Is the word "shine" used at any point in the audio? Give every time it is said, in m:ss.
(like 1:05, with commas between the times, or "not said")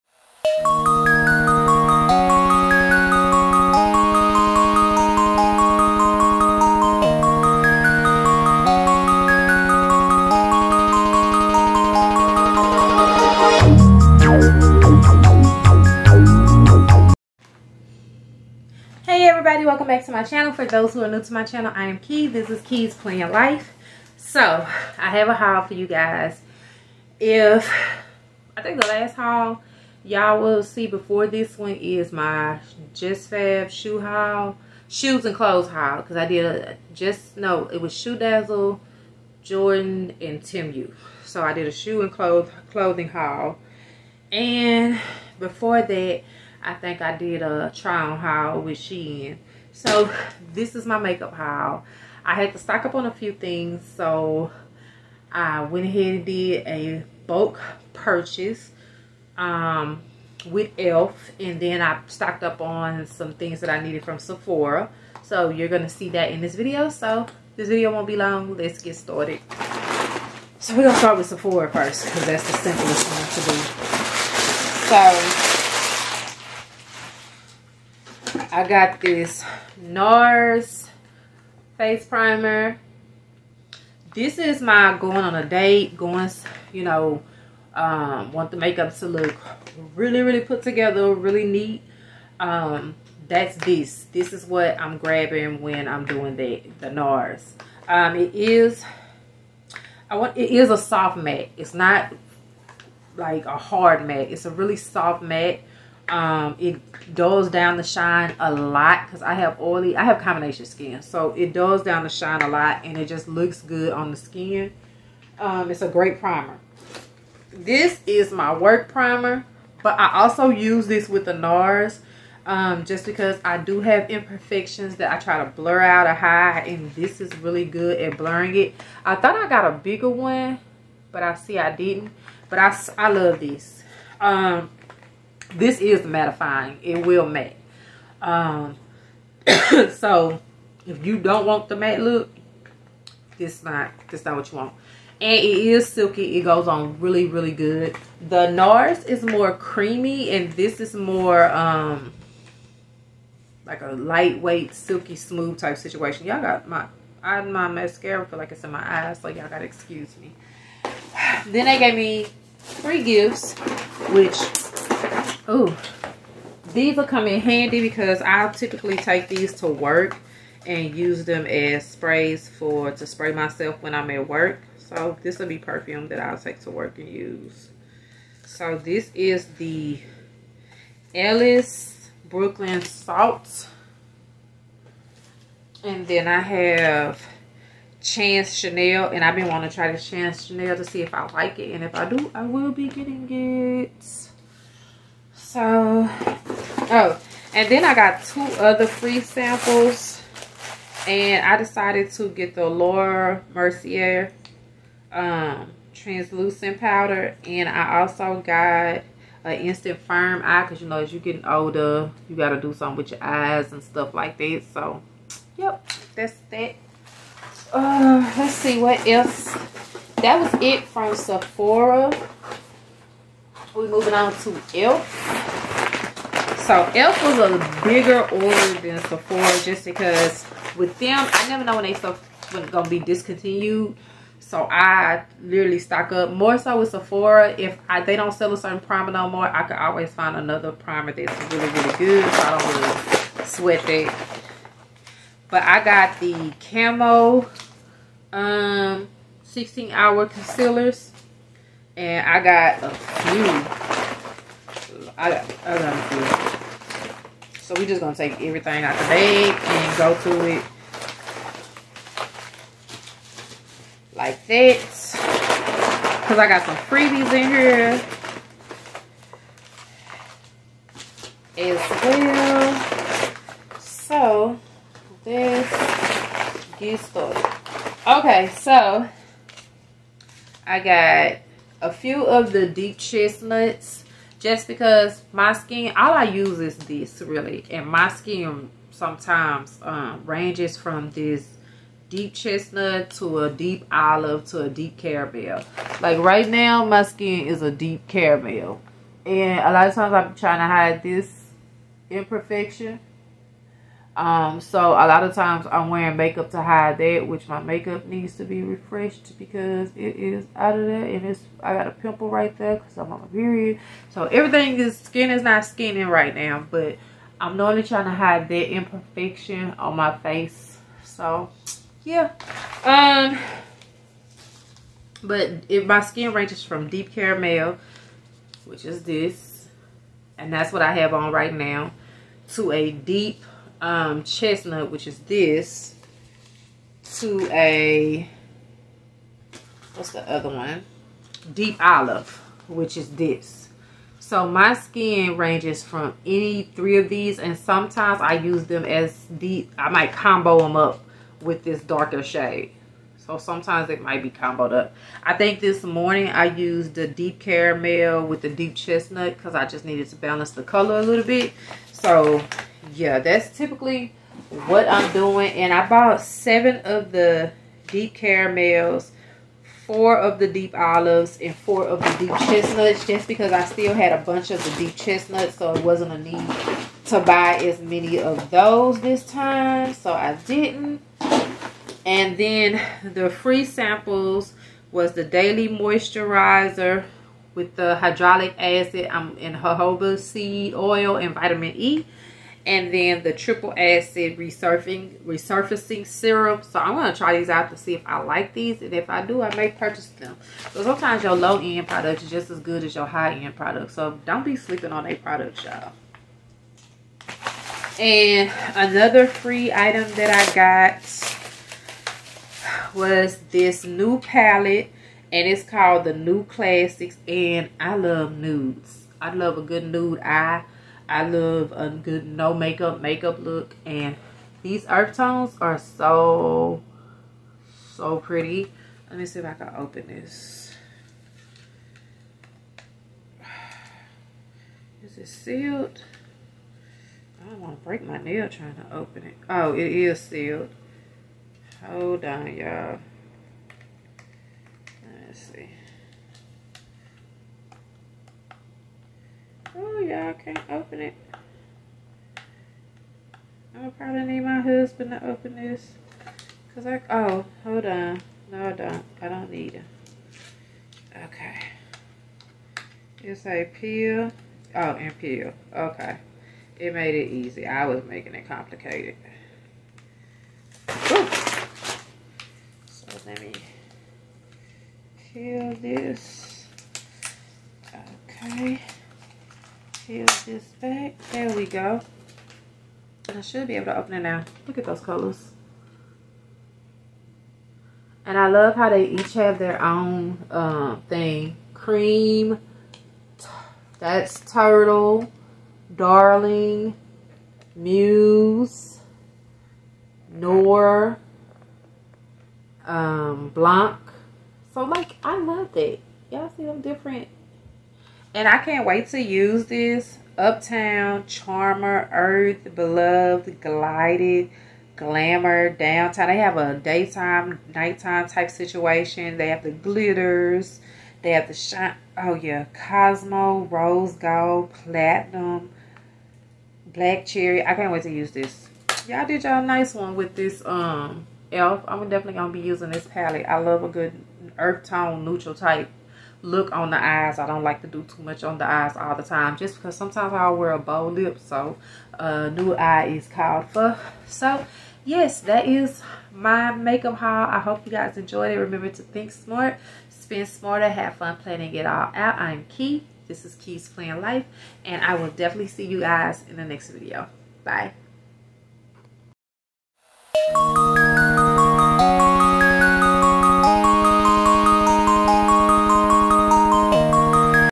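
1:47, 1:52, 8:41.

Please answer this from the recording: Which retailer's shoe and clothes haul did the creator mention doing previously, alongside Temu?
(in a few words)
ShoeDazzle.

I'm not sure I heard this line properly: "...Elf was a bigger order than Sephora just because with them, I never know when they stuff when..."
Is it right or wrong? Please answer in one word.
right.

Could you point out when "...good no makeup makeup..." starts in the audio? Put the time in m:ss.
7:01.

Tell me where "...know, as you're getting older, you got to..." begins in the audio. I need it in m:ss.
3:30.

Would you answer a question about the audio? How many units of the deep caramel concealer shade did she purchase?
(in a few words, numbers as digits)
7.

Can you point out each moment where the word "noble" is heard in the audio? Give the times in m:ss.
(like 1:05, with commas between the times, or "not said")
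not said.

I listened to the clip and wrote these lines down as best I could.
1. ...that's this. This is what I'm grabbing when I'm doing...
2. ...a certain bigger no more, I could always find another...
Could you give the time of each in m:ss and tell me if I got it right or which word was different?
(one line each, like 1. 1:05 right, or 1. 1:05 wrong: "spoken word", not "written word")
1. 1:33 right
2. 3:58 wrong: "primer", not "bigger".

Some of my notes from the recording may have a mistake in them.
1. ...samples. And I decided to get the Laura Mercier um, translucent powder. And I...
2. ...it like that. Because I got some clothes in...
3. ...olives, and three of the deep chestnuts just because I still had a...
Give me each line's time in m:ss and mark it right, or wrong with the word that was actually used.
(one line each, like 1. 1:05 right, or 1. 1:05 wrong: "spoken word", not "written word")
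1. 3:19 right
2. 4:20 wrong: "freebies", not "clothes"
3. 6:10 wrong: "four", not "three".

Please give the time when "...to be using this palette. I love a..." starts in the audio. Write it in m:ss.
8:52.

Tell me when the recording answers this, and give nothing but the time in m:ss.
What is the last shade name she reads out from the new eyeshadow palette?
8:46.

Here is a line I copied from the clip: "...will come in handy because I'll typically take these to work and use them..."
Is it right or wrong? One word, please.
right.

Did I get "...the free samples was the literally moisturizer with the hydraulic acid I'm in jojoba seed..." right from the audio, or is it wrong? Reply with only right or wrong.
wrong.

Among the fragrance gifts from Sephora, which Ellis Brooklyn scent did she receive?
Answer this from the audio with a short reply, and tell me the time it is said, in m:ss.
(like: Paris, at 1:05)
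Salt, at 3:01.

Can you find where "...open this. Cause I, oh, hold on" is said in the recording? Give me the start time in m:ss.
7:35.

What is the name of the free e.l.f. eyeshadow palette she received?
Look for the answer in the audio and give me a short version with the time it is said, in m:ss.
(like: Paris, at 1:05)
The New Classics, at 6:56.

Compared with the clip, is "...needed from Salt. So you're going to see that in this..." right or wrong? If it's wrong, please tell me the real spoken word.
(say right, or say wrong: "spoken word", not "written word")
wrong: "Sephora", not "Salt".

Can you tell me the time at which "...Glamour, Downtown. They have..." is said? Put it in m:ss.
8:34.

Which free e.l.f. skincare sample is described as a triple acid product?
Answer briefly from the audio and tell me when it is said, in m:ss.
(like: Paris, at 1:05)
resurfacing serum, at 6:35.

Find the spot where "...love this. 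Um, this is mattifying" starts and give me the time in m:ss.
2:13.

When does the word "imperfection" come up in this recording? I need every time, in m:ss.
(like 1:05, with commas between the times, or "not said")
2:04, 5:02, 5:18.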